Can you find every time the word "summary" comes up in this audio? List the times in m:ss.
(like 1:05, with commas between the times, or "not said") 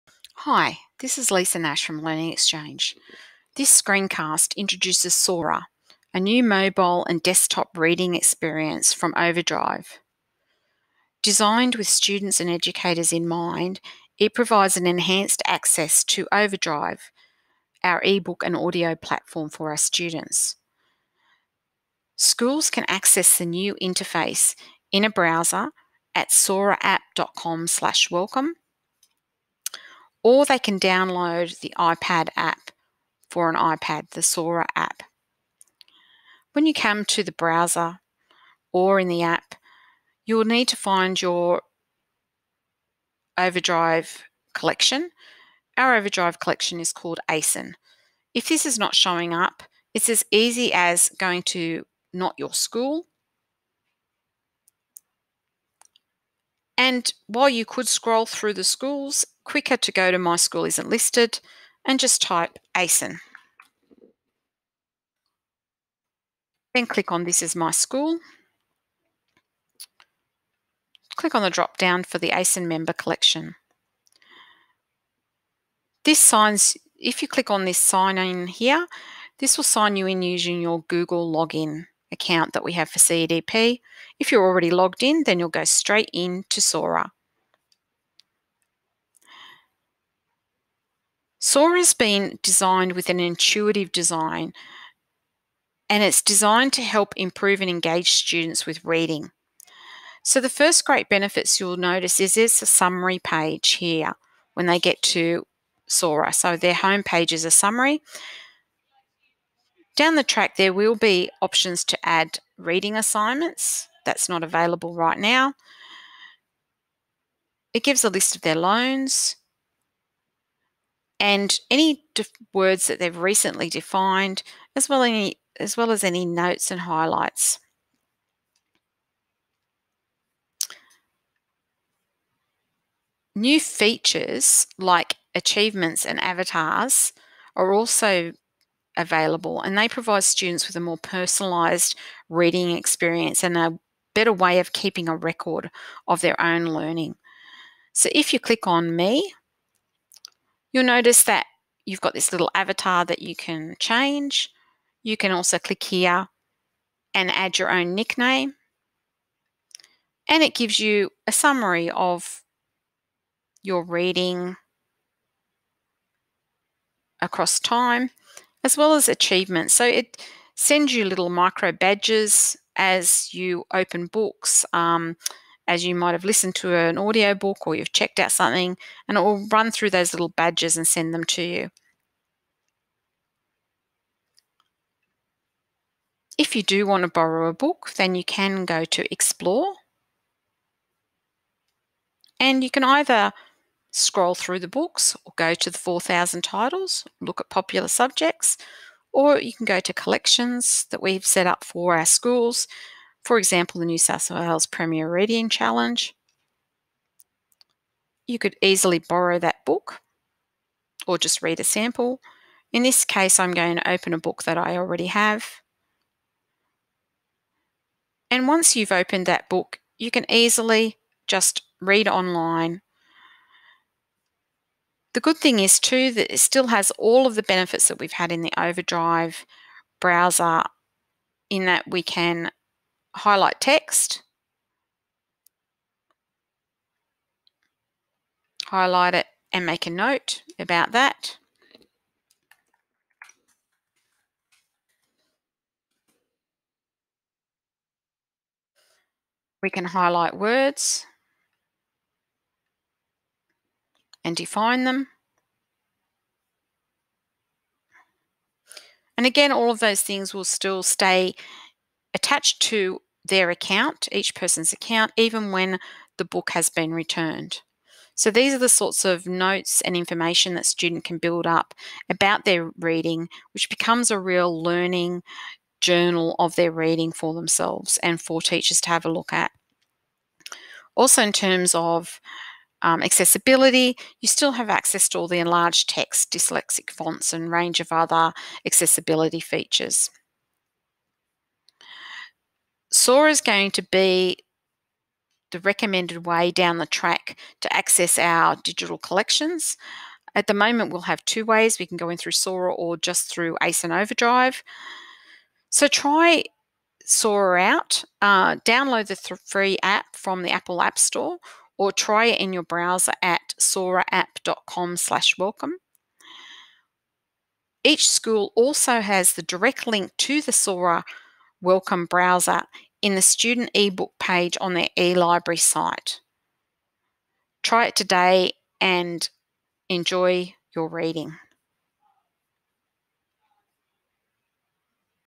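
1:42, 1:47, 2:41.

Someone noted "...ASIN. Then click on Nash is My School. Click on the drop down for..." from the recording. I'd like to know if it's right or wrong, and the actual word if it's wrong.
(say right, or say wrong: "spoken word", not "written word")
wrong: "This", not "Nash".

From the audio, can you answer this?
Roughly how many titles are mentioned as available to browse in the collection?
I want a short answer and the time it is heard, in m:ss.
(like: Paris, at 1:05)
4,000, at 3:15.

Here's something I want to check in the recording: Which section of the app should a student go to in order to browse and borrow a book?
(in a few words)
Explore.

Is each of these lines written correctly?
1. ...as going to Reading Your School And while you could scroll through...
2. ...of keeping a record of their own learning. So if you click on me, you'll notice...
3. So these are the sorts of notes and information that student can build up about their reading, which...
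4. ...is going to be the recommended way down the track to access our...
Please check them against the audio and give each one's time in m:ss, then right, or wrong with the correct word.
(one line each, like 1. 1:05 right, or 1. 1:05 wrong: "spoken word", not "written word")
1. 0:50 wrong: "Not", not "Reading"
2. 2:24 right
3. 4:28 right
4. 4:53 right.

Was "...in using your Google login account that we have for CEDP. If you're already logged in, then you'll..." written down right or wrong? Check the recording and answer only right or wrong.
right.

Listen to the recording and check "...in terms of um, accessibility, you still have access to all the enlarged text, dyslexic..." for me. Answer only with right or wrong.
right.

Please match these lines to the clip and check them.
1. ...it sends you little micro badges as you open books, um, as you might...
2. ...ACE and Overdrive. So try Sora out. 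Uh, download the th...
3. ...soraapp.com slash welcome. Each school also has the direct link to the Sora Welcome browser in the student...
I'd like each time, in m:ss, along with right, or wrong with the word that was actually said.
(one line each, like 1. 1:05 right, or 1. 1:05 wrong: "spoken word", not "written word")
1. 2:49 right
2. 5:03 right
3. 5:13 right.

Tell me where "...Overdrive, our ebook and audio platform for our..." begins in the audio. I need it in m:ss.
0:16.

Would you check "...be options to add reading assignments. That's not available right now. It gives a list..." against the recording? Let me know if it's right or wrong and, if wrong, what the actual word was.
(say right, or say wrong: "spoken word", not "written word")
right.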